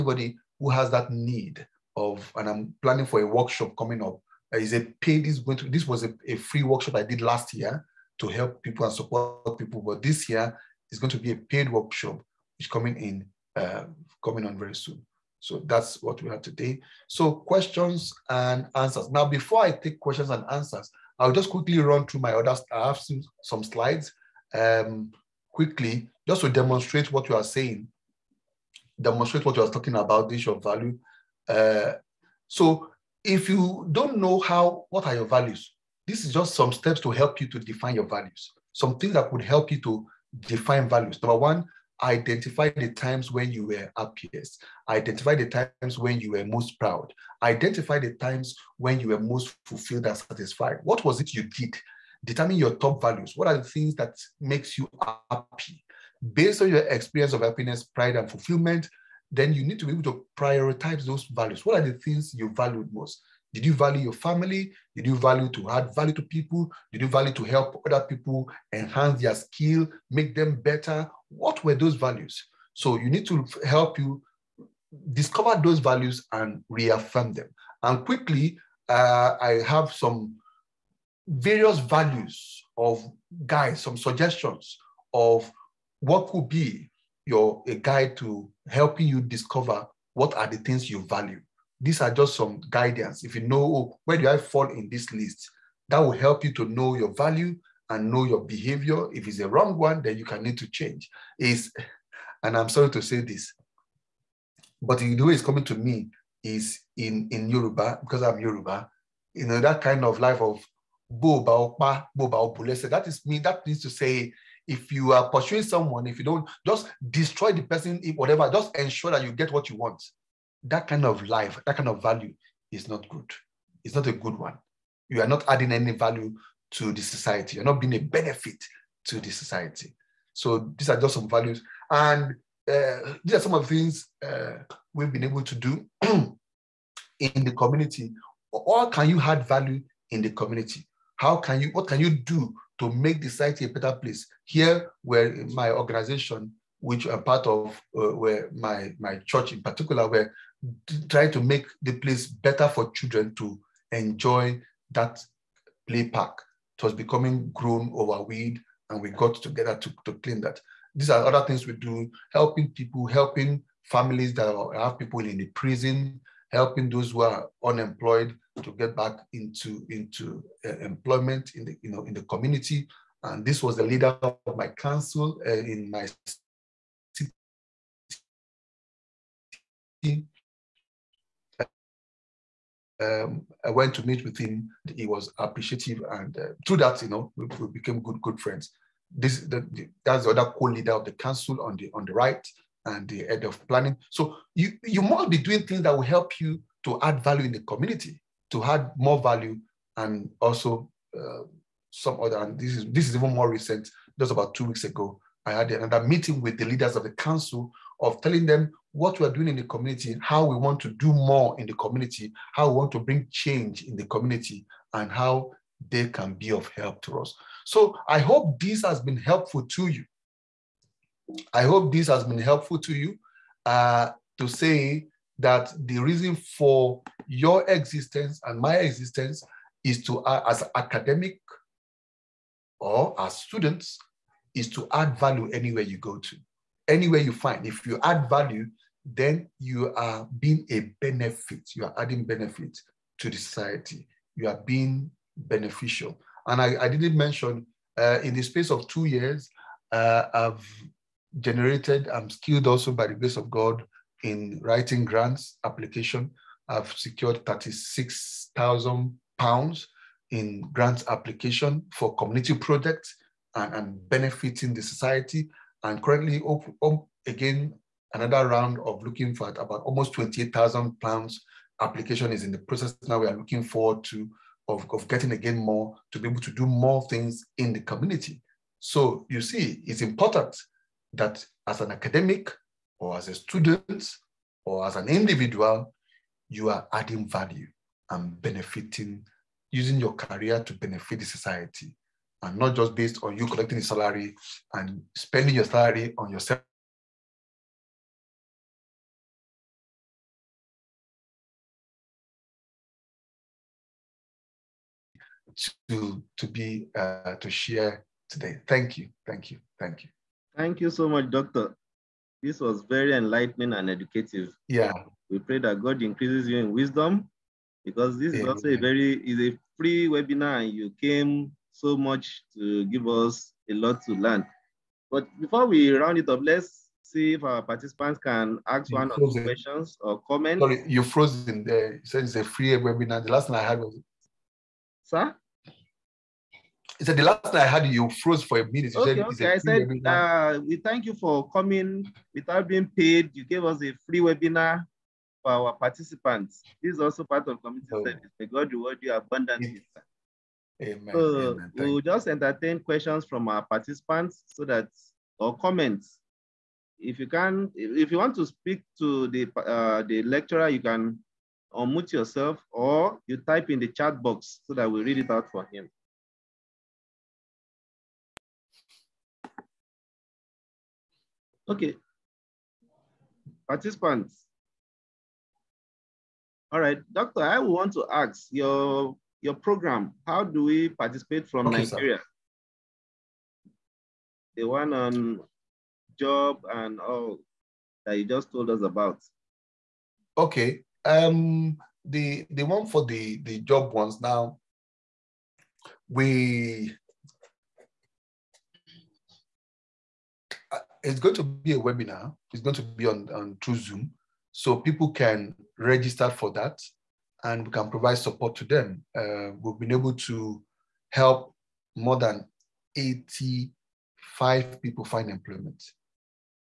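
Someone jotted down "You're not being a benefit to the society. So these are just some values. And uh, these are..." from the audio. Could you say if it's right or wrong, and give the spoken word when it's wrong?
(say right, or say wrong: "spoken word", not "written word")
right.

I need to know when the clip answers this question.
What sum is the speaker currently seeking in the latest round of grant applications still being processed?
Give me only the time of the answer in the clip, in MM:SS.
04:30.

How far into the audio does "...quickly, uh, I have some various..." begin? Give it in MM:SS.
01:18.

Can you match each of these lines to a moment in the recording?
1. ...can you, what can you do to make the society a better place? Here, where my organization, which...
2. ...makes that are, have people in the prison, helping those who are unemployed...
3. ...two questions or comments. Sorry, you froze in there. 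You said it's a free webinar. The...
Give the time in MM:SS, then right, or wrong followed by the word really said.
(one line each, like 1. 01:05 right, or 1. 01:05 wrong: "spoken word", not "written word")
1. 02:21 right
2. 02:43 wrong: "families", not "makes"
3. 05:29 right.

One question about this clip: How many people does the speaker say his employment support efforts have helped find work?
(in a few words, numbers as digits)
85.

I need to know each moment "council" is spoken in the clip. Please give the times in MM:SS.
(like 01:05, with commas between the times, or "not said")
02:54, 03:11, 03:27.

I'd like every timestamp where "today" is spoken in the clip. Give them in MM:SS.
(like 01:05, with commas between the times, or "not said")
00:16, 05:08.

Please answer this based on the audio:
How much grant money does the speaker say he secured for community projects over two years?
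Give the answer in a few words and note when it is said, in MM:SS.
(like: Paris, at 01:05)
£36,000, at 04:17.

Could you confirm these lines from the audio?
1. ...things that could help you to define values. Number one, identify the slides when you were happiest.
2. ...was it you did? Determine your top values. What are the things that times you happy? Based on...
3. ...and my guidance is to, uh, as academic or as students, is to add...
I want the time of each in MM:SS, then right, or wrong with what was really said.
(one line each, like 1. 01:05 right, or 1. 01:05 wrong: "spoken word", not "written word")
1. 00:38 wrong: "times", not "slides"
2. 00:51 wrong: "makes", not "times"
3. 03:48 wrong: "existence", not "guidance".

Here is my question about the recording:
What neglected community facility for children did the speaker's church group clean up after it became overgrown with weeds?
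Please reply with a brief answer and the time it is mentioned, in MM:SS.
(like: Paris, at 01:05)
play park, at 02:35.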